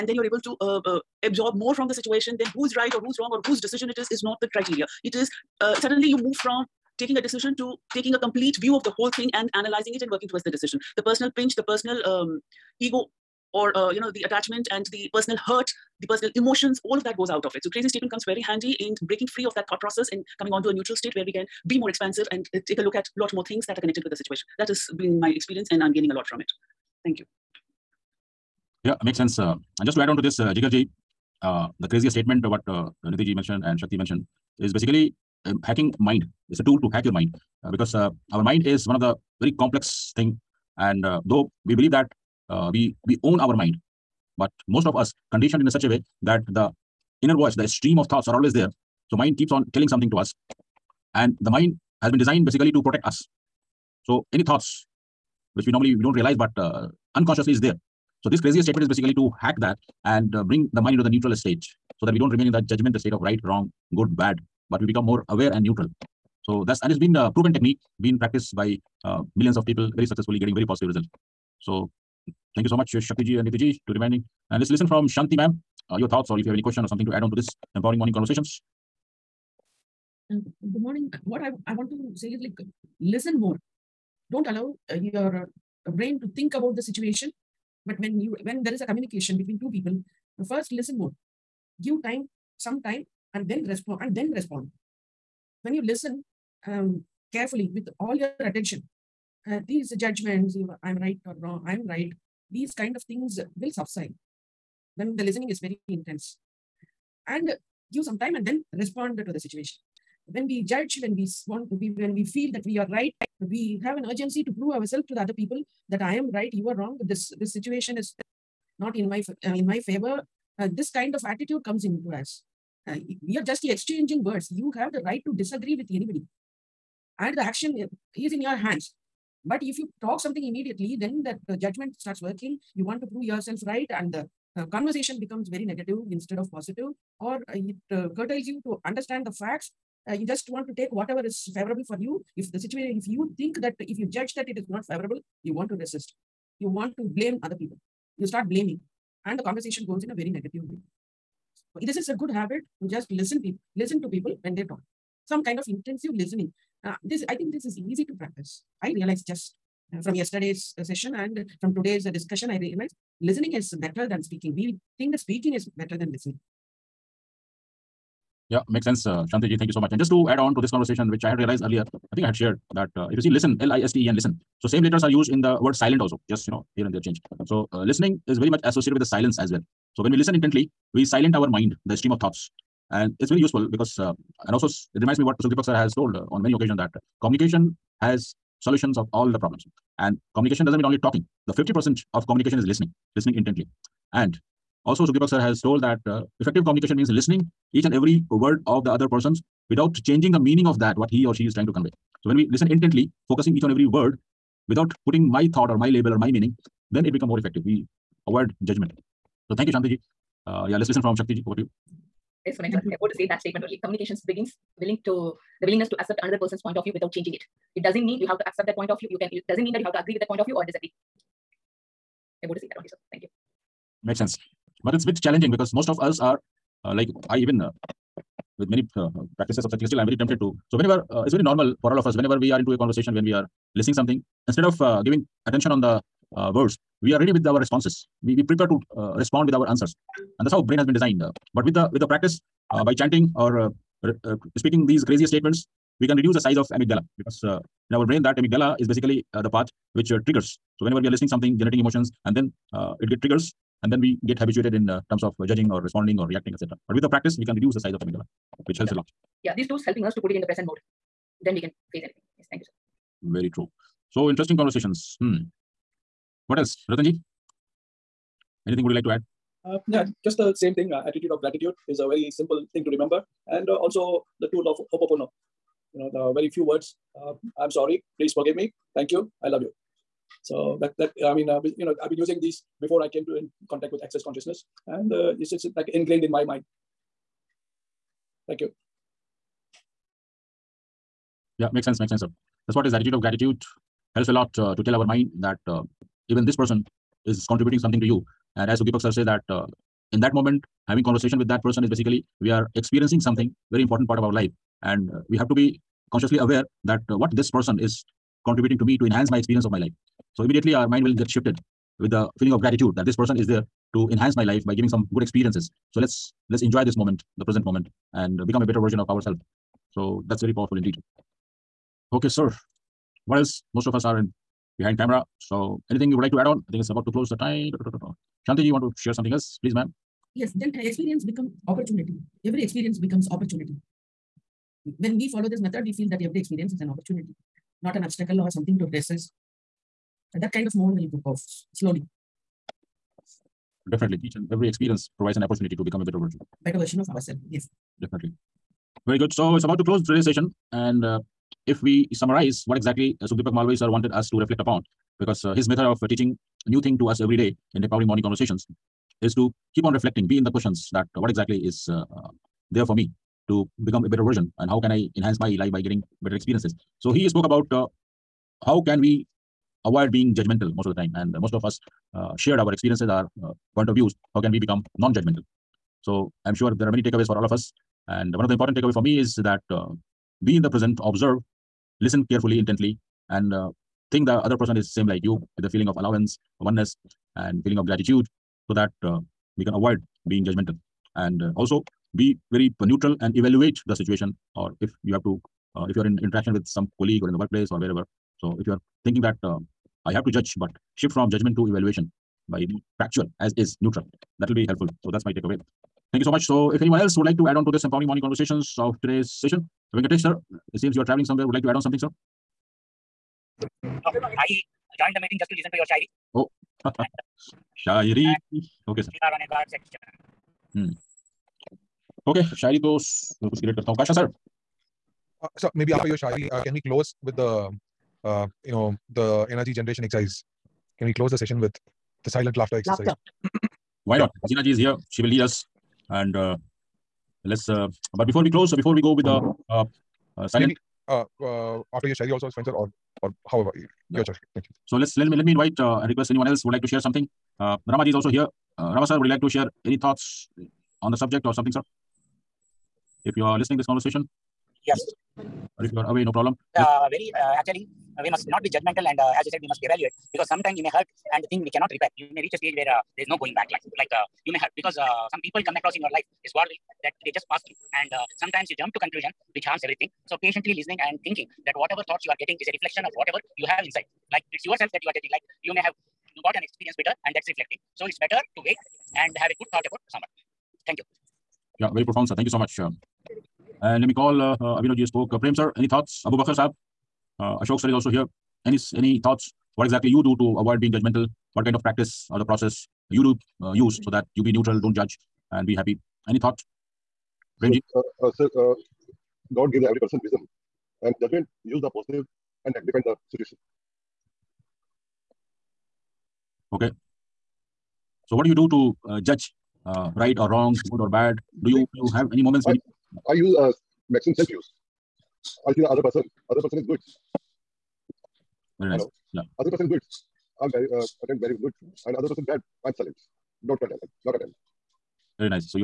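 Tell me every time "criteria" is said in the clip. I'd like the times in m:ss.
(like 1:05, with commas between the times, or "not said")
0:04.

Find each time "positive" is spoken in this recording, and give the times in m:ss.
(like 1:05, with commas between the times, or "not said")
1:10, 2:16, 8:21.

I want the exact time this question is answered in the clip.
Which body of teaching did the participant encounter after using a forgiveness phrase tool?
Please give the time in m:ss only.
4:44.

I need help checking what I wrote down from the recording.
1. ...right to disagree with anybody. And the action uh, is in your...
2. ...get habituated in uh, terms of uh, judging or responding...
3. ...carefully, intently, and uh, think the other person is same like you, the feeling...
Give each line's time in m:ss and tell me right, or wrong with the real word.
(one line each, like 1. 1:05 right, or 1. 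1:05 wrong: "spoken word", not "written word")
1. 2:05 right
2. 4:14 right
3. 6:22 right.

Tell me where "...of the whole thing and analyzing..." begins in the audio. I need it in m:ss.
0:08.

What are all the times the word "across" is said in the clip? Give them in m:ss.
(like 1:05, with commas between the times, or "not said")
7:45.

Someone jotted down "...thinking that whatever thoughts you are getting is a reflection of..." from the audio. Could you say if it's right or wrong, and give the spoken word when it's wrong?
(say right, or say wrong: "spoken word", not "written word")
right.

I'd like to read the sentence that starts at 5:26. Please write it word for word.
I think it's about to close the time.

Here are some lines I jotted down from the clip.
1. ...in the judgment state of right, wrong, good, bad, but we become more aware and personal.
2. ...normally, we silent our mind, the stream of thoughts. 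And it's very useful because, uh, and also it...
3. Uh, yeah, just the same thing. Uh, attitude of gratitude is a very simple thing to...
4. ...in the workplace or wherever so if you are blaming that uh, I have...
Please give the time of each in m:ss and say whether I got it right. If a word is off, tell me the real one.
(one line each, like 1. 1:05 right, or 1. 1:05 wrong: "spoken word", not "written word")
1. 1:02 wrong: "neutral", not "personal"
2. 3:00 wrong: "intently", not "normally"
3. 4:29 right
4. 6:37 wrong: "thinking", not "blaming".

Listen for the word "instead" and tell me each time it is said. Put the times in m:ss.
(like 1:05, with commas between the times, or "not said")
2:16, 3:54.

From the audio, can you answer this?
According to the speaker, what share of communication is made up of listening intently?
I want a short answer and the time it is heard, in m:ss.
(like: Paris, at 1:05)
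50%, at 3:11.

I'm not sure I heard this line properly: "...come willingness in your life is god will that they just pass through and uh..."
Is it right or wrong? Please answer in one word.
wrong.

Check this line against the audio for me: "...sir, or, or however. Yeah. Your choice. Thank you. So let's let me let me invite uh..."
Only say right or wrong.
right.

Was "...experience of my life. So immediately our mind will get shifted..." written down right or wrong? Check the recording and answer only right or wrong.
right.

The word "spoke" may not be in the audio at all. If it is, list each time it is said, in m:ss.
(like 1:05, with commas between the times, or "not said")
6:07, 8:05.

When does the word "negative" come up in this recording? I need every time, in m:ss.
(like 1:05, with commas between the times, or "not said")
2:15, 2:30.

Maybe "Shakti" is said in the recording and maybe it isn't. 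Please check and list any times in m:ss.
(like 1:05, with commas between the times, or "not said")
0:33, 1:13, 3:31.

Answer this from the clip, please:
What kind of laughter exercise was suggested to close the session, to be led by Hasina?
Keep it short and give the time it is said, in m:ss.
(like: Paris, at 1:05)
silent laughter, at 7:12.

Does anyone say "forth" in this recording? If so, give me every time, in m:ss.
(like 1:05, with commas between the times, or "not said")
not said.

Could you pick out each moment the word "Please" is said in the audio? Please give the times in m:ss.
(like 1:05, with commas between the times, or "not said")
4:38, 5:29.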